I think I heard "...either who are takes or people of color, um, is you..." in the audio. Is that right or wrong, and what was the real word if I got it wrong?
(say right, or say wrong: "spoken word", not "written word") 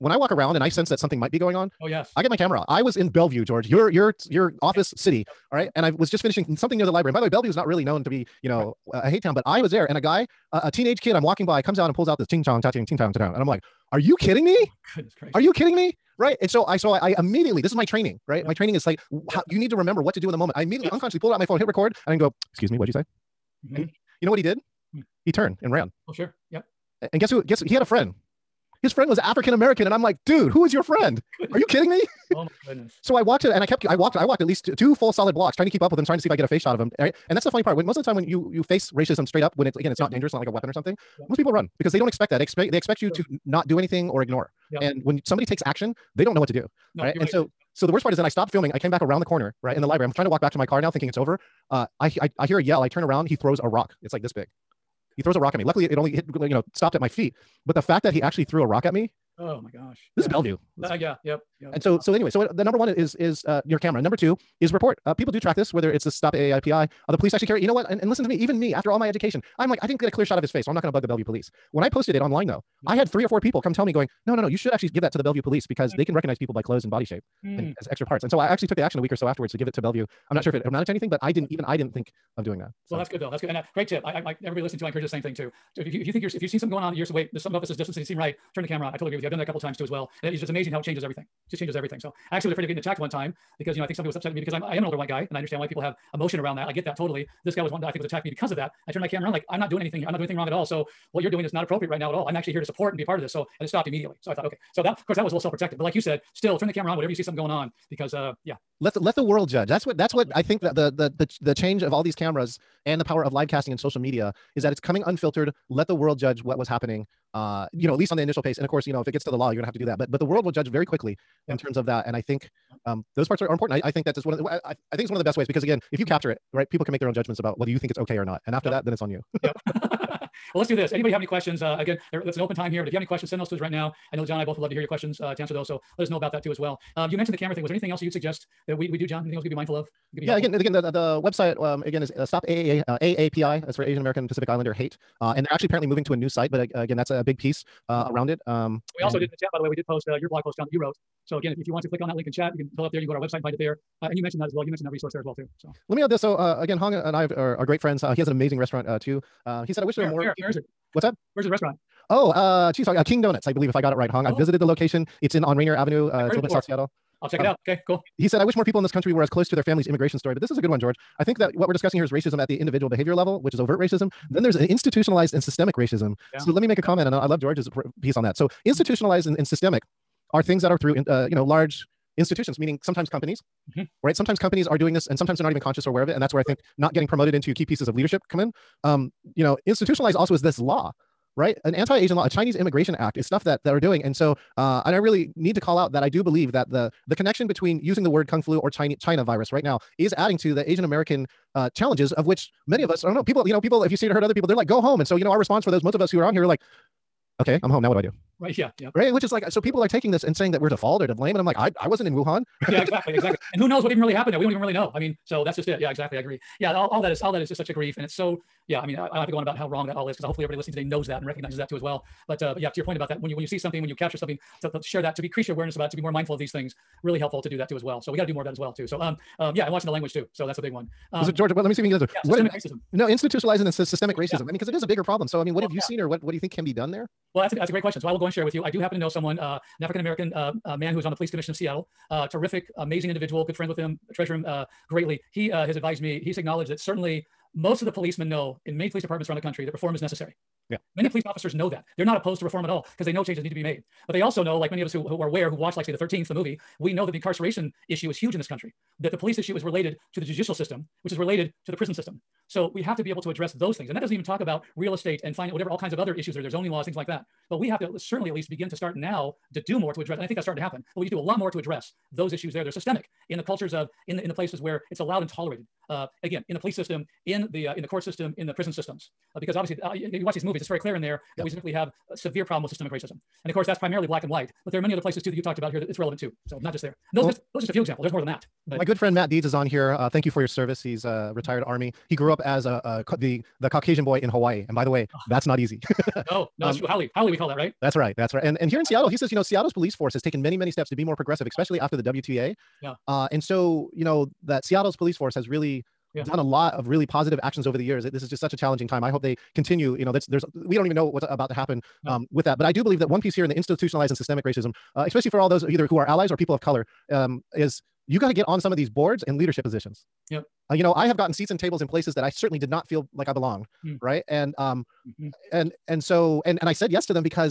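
wrong: "allies", not "takes".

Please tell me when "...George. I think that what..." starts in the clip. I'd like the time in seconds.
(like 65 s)
170 s.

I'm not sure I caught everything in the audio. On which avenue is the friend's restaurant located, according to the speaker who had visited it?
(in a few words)
Rainier Avenue.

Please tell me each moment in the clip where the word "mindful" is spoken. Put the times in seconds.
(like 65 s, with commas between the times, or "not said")
139 s, 226 s.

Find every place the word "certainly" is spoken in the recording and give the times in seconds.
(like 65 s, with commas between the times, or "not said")
246 s, 267 s, 322 s.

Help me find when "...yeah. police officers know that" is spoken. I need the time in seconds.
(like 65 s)
251 s.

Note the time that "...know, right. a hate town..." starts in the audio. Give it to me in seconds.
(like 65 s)
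8 s.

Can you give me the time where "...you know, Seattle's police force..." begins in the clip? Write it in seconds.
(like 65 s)
299 s.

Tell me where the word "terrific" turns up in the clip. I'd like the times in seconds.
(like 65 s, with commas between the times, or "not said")
242 s.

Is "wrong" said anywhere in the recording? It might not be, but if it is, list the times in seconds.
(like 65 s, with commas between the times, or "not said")
100 s, 219 s.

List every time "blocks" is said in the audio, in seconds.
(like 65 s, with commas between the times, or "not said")
35 s.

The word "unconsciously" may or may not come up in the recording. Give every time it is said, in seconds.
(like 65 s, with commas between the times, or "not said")
20 s.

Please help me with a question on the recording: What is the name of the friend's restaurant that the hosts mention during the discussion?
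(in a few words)
King Donuts.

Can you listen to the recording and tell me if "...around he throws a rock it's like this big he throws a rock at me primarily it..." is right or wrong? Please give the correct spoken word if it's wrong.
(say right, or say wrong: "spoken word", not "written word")
wrong: "luckily", not "primarily".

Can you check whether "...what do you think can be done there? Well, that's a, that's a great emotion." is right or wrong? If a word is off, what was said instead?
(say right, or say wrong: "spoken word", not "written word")
wrong: "question", not "emotion".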